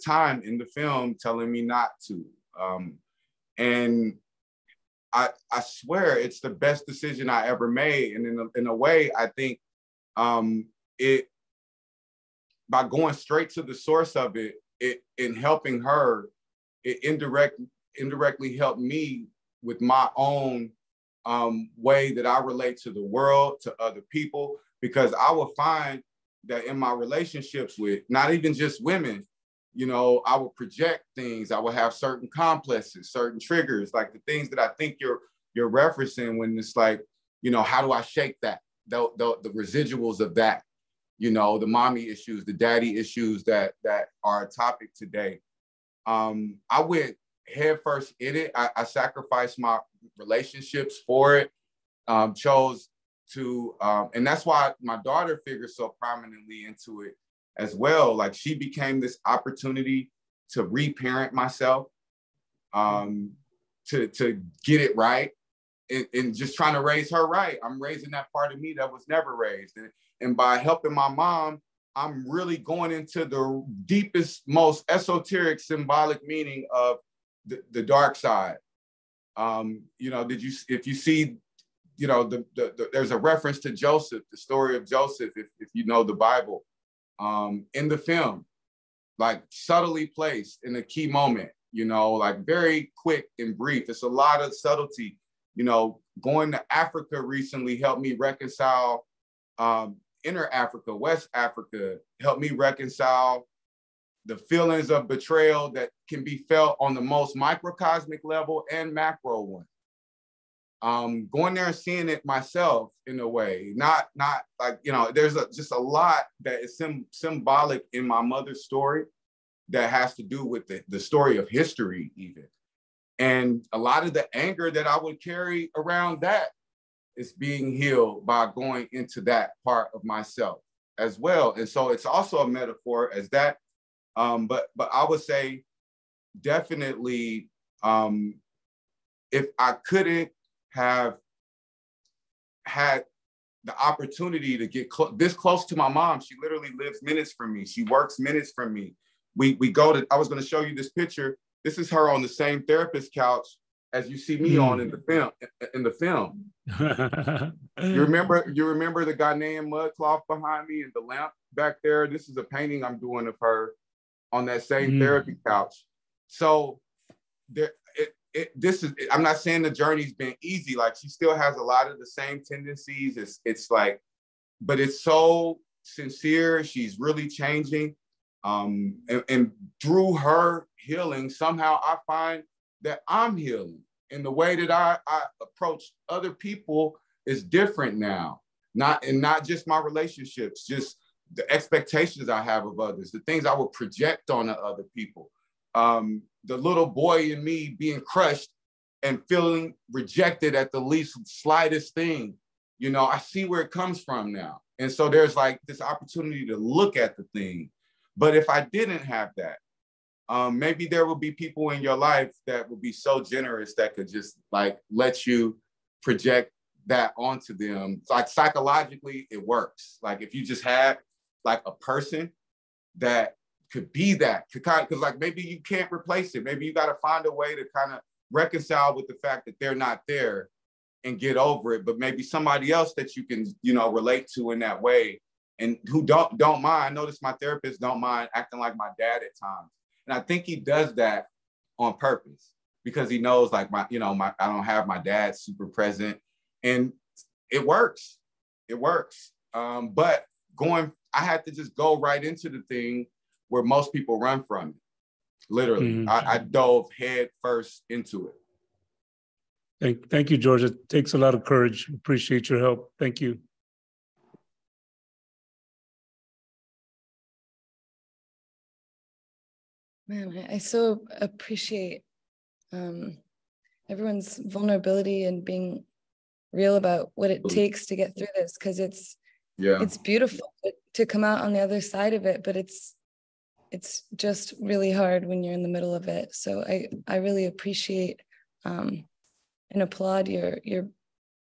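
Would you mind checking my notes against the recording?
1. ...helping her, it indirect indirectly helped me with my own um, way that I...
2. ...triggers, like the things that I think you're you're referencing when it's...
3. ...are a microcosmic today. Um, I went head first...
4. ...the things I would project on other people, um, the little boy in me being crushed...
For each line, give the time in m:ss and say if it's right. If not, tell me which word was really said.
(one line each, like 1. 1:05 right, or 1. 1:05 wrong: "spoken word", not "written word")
1. 0:15 right
2. 0:33 right
3. 0:44 wrong: "topic", not "microcosmic"
4. 3:13 right.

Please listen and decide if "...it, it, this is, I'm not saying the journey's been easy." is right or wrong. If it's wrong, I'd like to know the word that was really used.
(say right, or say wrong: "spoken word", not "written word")
right.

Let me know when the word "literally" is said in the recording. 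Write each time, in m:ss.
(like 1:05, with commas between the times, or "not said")
2:26, 4:15.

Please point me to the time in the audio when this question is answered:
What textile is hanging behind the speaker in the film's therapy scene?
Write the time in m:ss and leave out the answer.
2:39.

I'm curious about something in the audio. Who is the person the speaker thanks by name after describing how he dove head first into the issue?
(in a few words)
George.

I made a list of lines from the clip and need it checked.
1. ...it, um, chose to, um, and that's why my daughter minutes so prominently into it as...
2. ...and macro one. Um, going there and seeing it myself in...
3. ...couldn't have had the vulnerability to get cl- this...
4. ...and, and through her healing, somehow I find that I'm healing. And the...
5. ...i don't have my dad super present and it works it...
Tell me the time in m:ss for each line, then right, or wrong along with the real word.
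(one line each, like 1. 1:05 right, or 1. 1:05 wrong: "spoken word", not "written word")
1. 0:51 wrong: "figures", not "minutes"
2. 1:48 right
3. 2:19 wrong: "opportunity", not "vulnerability"
4. 2:59 right
5. 4:04 right.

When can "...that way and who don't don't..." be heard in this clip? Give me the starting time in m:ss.
3:54.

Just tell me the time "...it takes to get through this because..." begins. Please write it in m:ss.
4:37.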